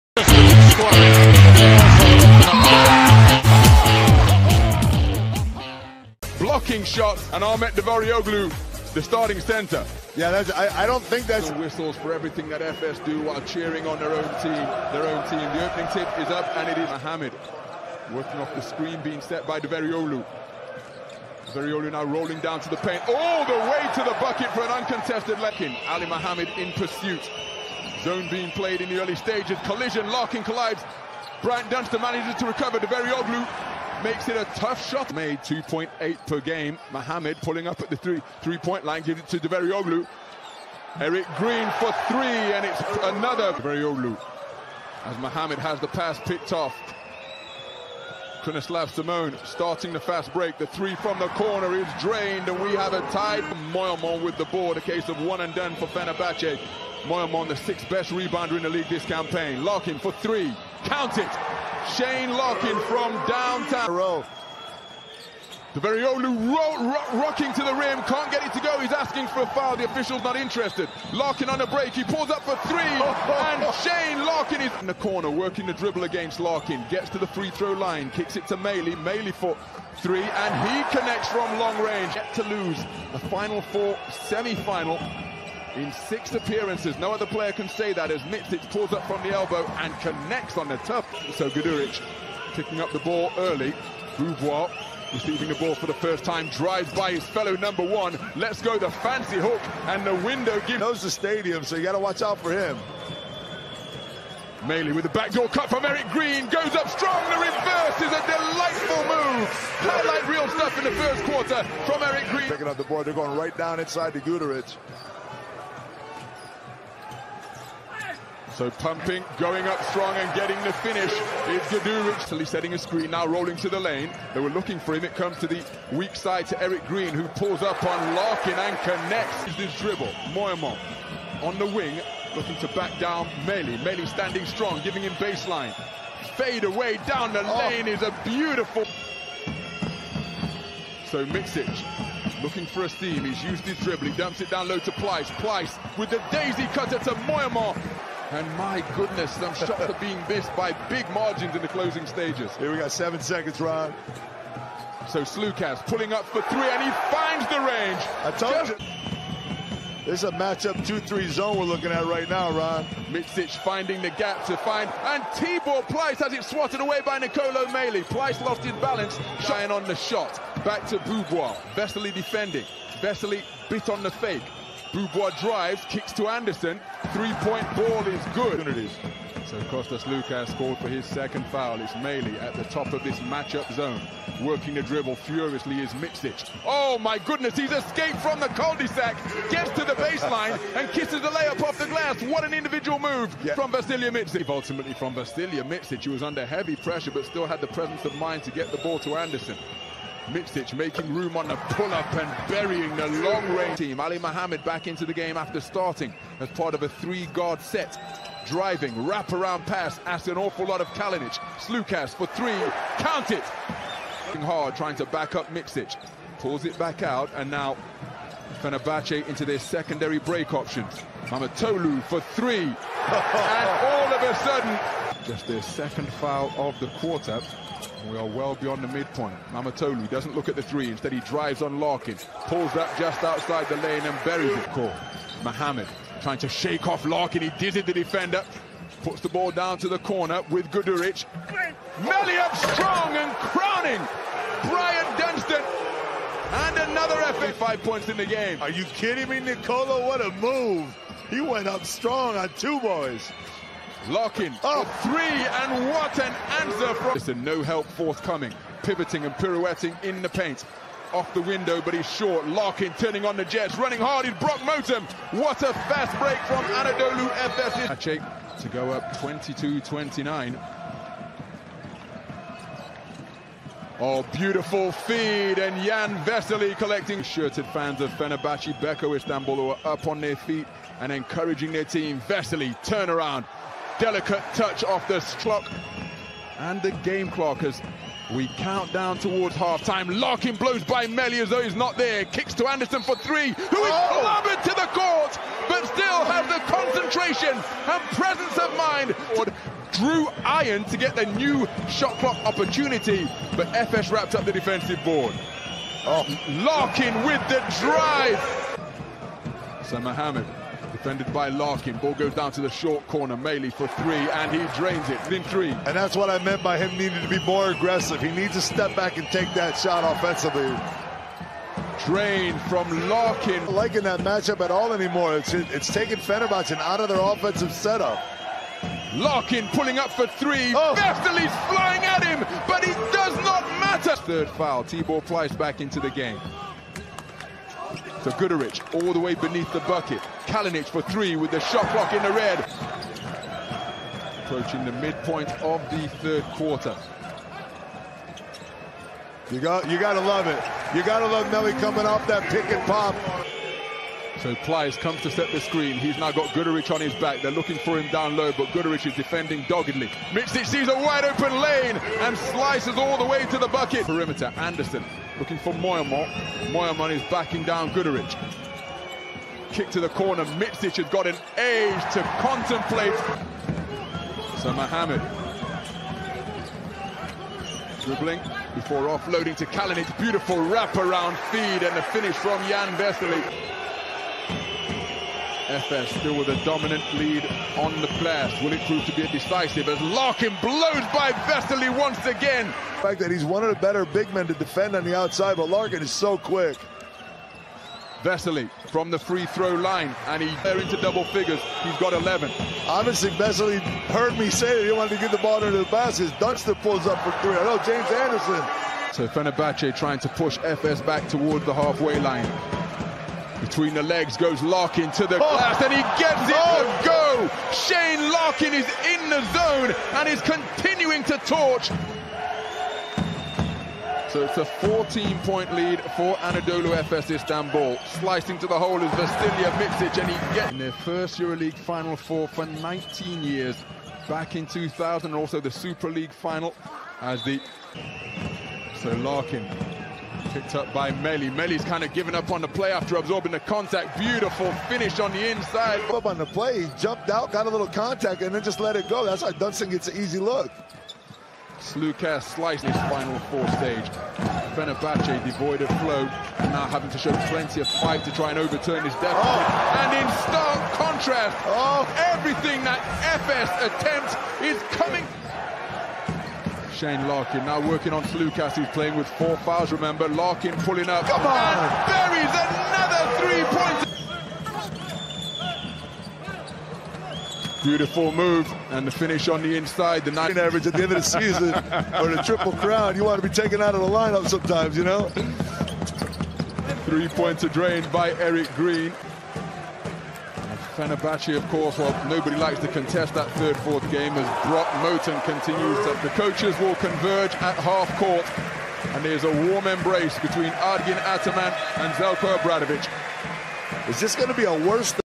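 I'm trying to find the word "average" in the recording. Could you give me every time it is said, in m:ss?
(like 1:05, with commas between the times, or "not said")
8:00.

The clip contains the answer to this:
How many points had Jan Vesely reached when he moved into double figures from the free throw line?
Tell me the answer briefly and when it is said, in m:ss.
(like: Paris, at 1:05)
11, at 6:42.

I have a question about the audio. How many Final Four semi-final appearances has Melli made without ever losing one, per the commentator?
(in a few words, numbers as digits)
6.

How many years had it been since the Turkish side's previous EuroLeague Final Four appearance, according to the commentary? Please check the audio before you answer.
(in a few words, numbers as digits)
19 years.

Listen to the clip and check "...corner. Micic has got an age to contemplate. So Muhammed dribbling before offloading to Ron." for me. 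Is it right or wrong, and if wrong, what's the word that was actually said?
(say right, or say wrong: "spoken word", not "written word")
wrong: "Kalinic", not "Ron".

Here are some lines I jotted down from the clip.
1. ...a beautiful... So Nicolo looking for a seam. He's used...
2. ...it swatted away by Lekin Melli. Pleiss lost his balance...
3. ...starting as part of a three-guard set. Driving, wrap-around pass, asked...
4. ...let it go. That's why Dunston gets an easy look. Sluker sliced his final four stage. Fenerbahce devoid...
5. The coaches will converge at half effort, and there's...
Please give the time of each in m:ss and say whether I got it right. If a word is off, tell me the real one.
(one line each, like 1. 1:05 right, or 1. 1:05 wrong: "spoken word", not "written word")
1. 2:18 wrong: "Micic", not "Nicolo"
2. 2:46 wrong: "Nicolo", not "Lekin"
3. 3:25 right
4. 7:28 right
5. 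8:16 wrong: "court", not "effort".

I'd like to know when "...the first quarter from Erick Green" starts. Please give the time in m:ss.
1:50.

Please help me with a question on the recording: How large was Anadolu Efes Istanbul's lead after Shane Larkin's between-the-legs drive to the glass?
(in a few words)
14 points.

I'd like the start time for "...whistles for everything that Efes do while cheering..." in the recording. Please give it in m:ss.
0:11.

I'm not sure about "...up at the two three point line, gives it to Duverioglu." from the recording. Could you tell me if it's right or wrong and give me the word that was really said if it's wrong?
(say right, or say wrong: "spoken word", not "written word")
wrong: "three", not "two".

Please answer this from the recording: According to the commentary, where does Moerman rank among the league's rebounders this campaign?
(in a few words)
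sixth best.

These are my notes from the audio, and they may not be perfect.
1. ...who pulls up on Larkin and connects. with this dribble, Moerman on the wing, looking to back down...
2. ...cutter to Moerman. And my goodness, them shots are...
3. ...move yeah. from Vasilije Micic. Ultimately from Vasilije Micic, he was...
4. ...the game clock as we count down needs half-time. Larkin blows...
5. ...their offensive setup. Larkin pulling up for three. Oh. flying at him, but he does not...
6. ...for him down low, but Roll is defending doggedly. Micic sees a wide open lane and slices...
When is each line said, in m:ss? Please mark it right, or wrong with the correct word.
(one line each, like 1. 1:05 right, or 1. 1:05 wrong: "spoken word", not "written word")
1. 2:07 right
2. 2:26 right
3. 3:12 right
4. 4:46 wrong: "towards", not "needs"
5. 5:27 right
6. 5:57 wrong: "Guduric", not "Roll".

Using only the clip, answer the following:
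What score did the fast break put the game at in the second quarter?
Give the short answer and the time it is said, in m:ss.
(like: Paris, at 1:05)
22-29, at 4:29.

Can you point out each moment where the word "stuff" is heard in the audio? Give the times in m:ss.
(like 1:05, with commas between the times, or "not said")
1:50.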